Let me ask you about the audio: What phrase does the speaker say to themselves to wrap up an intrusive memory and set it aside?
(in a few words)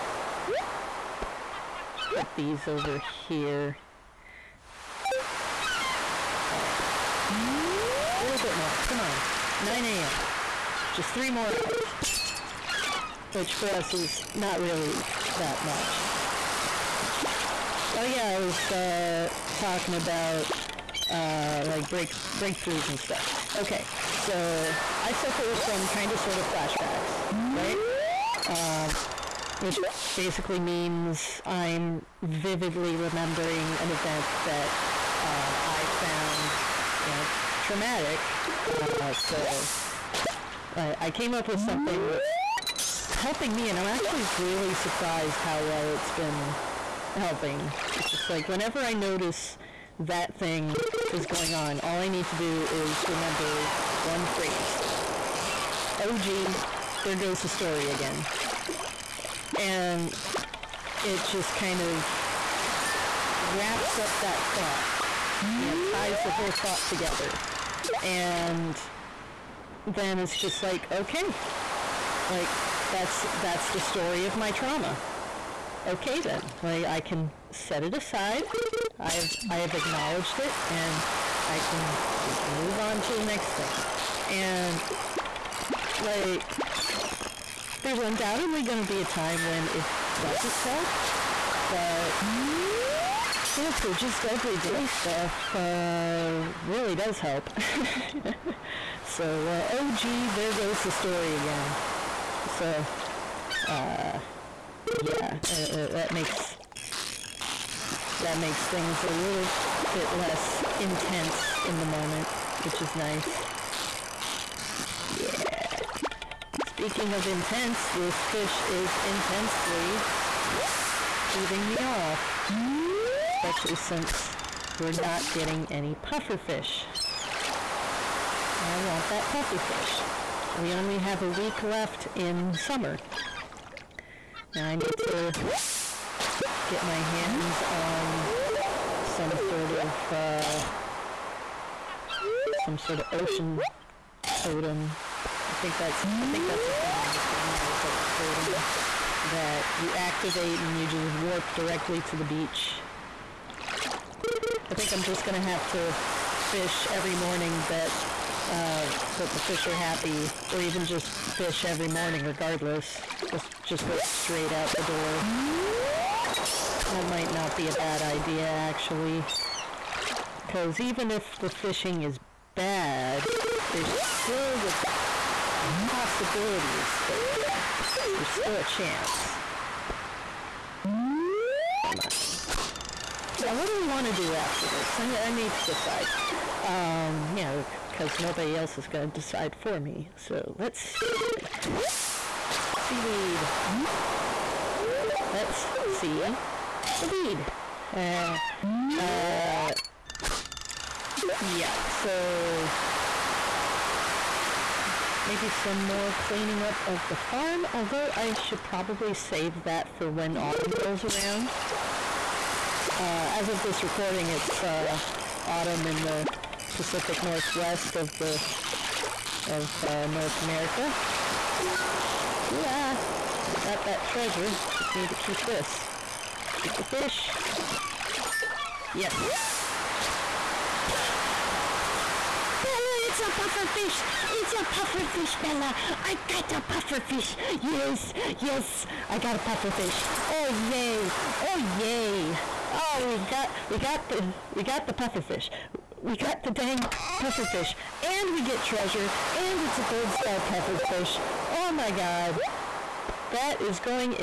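Oh geez, there goes the story again.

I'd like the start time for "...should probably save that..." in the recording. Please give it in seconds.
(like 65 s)
208 s.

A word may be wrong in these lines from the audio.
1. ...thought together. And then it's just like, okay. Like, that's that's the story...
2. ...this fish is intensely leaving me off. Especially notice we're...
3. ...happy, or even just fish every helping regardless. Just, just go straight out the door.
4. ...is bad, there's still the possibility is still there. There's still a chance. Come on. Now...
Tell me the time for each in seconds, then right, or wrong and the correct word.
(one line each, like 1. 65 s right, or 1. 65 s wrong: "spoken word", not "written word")
1. 66 s right
2. 117 s wrong: "since", not "notice"
3. 159 s wrong: "morning", not "helping"
4. 172 s right.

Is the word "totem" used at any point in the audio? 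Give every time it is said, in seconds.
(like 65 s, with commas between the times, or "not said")
144 s, 148 s.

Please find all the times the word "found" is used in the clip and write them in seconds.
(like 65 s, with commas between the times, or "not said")
37 s.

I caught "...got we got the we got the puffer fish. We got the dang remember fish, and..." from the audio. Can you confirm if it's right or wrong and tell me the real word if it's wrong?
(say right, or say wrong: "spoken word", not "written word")
wrong: "puffer", not "remember".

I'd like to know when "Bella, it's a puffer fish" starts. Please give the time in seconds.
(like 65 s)
232 s.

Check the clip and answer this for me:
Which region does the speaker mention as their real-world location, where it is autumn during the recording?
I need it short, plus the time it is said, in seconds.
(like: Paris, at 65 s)
Pacific Northwest, at 216 s.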